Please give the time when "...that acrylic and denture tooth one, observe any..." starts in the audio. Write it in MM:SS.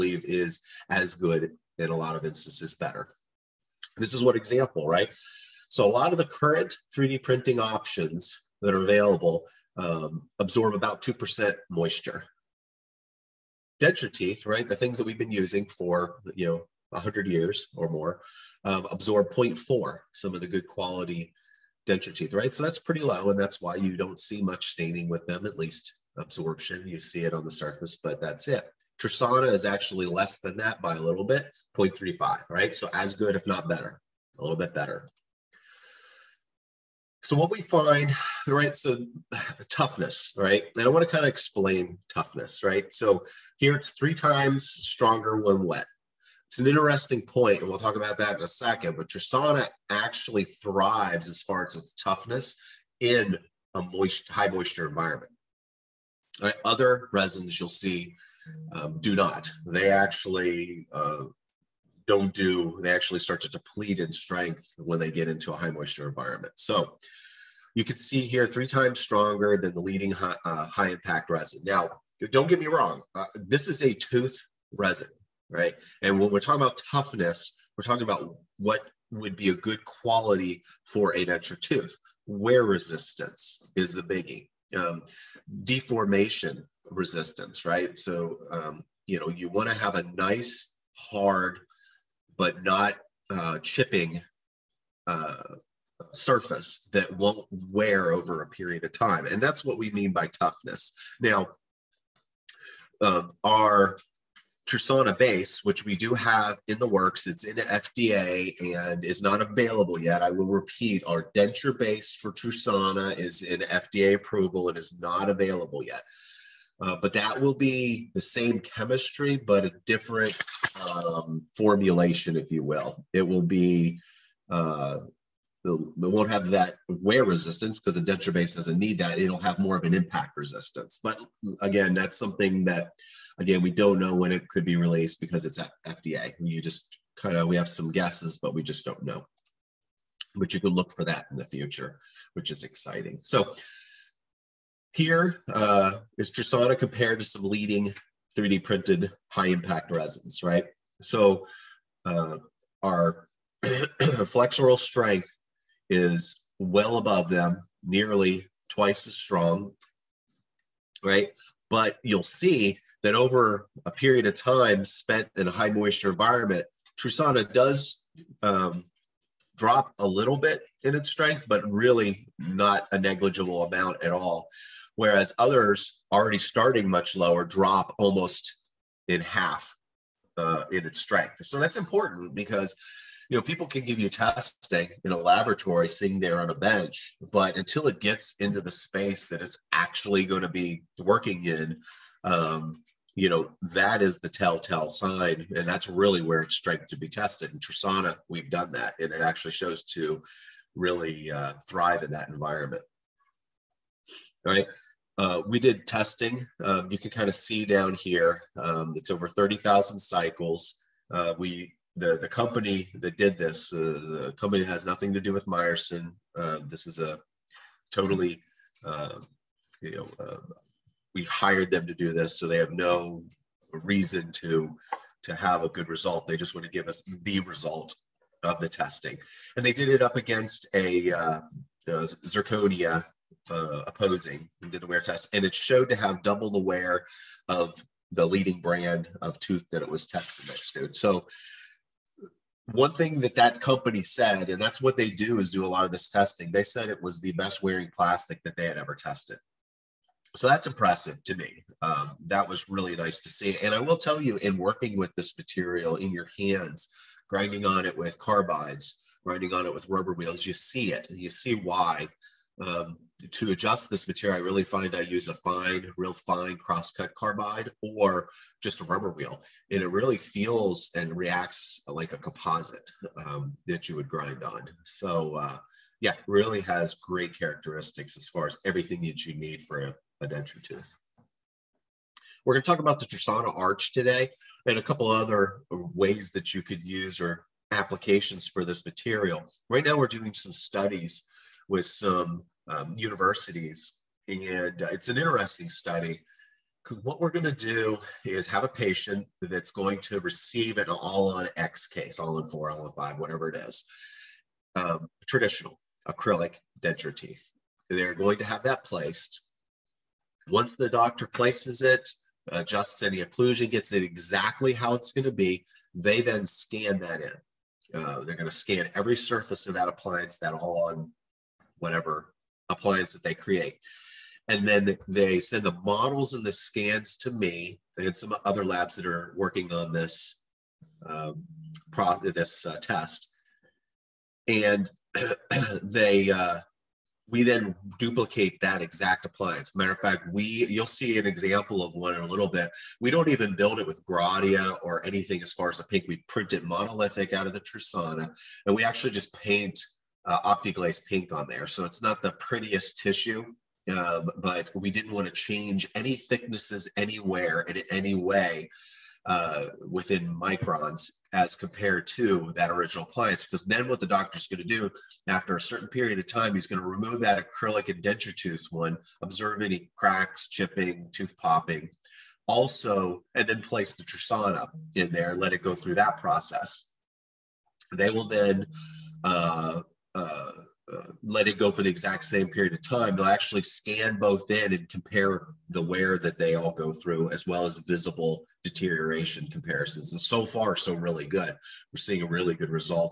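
06:07.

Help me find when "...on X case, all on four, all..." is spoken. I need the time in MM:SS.
05:01.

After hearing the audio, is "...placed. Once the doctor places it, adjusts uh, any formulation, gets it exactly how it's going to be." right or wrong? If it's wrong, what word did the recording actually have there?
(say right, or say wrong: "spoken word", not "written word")
wrong: "occlusion", not "formulation".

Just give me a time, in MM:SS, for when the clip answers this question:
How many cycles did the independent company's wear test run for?
03:29.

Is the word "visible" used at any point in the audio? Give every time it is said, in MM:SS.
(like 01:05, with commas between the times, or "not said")
06:27.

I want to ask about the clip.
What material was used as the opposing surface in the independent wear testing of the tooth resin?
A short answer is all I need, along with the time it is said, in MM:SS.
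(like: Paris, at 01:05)
zirconia, at 03:51.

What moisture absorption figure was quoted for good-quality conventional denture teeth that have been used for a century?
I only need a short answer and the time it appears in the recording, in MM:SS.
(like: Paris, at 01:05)
0.4, at 00:19.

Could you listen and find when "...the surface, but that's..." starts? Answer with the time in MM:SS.
00:27.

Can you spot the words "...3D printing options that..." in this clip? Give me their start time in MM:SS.
00:06.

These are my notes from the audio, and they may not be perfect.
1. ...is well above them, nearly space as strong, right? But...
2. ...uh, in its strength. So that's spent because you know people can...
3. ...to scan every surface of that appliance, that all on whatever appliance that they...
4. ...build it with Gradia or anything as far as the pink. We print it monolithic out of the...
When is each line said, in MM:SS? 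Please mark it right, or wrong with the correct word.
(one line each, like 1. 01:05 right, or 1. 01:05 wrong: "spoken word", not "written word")
1. 02:35 wrong: "twice", not "space"
2. 03:00 wrong: "important", not "spent"
3. 05:18 right
4. 05:43 right.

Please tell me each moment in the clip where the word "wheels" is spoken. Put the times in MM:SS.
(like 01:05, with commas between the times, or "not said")
04:20, 04:29.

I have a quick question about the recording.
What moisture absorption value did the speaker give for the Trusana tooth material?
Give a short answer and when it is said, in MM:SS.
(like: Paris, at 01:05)
0.35, at 00:31.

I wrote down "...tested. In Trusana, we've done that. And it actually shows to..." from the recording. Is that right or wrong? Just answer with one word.
right.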